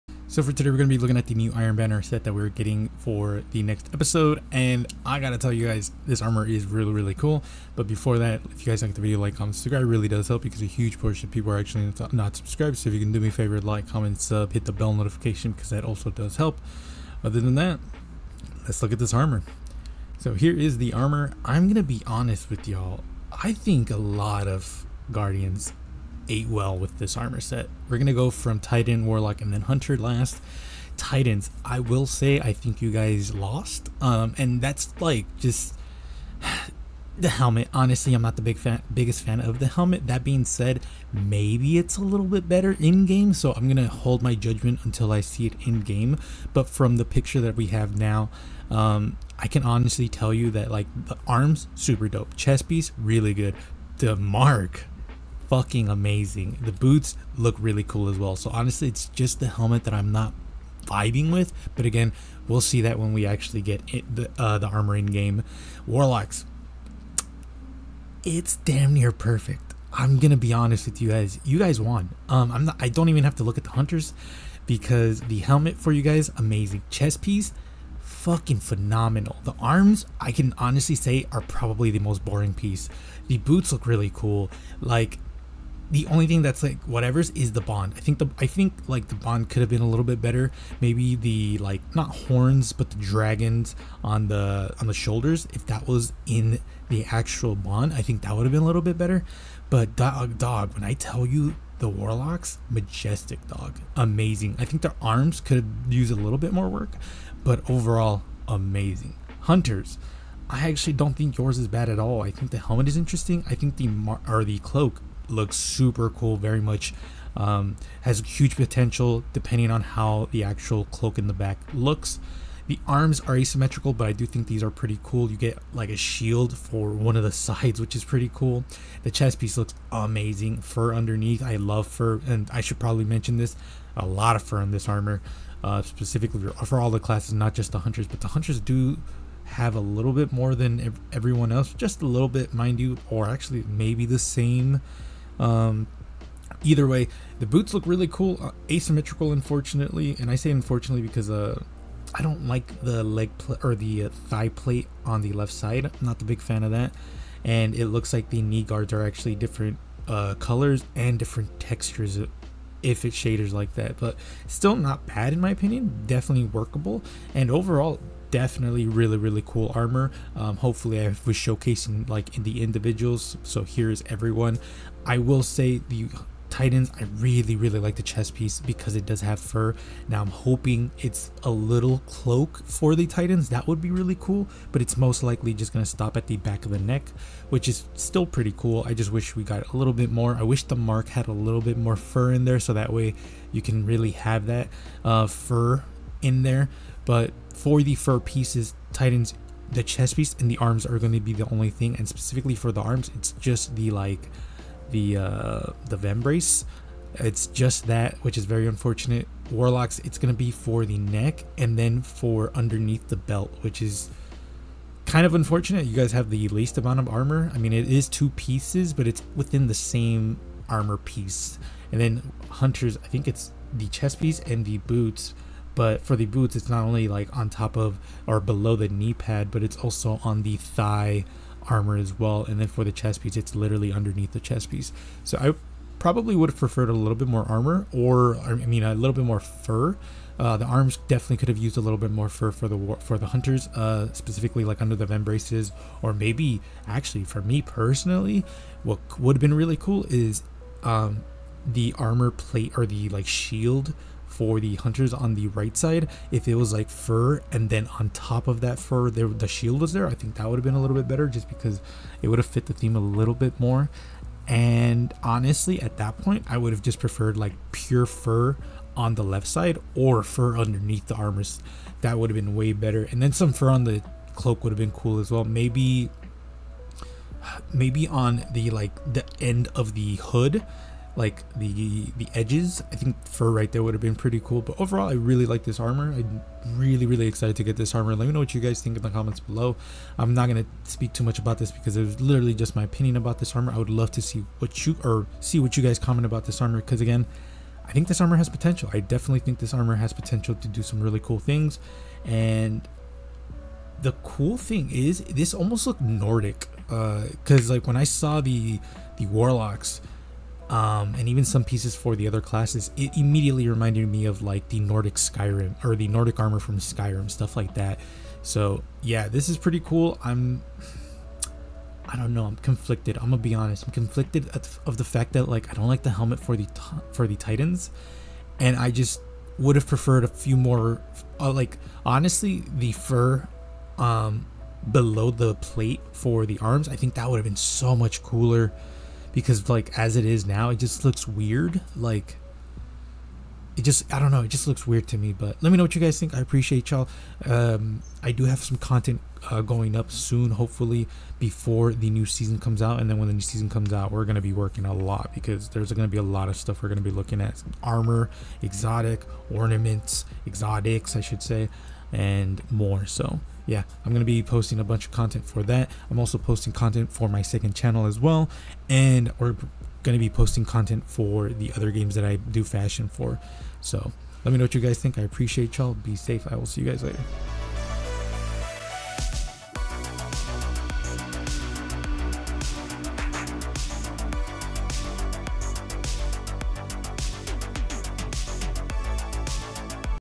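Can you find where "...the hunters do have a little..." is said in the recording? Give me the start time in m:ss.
2:18.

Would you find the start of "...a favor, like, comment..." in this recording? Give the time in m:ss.
0:13.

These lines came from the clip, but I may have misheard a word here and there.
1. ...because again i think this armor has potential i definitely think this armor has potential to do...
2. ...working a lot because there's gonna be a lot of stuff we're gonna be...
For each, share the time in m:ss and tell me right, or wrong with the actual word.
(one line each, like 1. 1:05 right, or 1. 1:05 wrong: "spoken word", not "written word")
1. 4:56 right
2. 5:54 right.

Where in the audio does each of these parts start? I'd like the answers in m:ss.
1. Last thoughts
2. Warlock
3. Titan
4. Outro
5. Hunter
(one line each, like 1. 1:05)
1. 2:54
2. 1:07
3. 0:30
4. 5:47
5. 1:50.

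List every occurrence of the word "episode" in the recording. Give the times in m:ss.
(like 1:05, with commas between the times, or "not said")
0:03.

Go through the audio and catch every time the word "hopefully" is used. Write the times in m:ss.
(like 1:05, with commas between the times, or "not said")
2:50, 5:50.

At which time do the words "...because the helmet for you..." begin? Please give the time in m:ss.
1:14.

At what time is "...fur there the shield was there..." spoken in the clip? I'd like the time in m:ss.
4:18.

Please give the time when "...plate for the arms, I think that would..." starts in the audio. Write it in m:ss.
5:35.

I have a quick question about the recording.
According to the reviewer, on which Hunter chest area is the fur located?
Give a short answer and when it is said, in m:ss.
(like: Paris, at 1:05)
Underneath the chest piece, at 3:53.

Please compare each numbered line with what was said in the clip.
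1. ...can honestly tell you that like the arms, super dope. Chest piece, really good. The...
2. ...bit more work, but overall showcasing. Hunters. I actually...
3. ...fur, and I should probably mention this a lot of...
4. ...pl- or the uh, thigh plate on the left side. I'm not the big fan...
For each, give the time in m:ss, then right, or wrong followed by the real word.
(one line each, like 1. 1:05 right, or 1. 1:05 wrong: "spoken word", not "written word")
1. 0:49 right
2. 1:46 wrong: "amazing", not "showcasing"
3. 2:11 right
4. 2:33 right.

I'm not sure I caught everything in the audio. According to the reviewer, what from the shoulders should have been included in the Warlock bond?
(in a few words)
The dragons.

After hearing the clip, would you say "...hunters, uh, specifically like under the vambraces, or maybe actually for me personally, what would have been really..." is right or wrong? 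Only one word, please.
right.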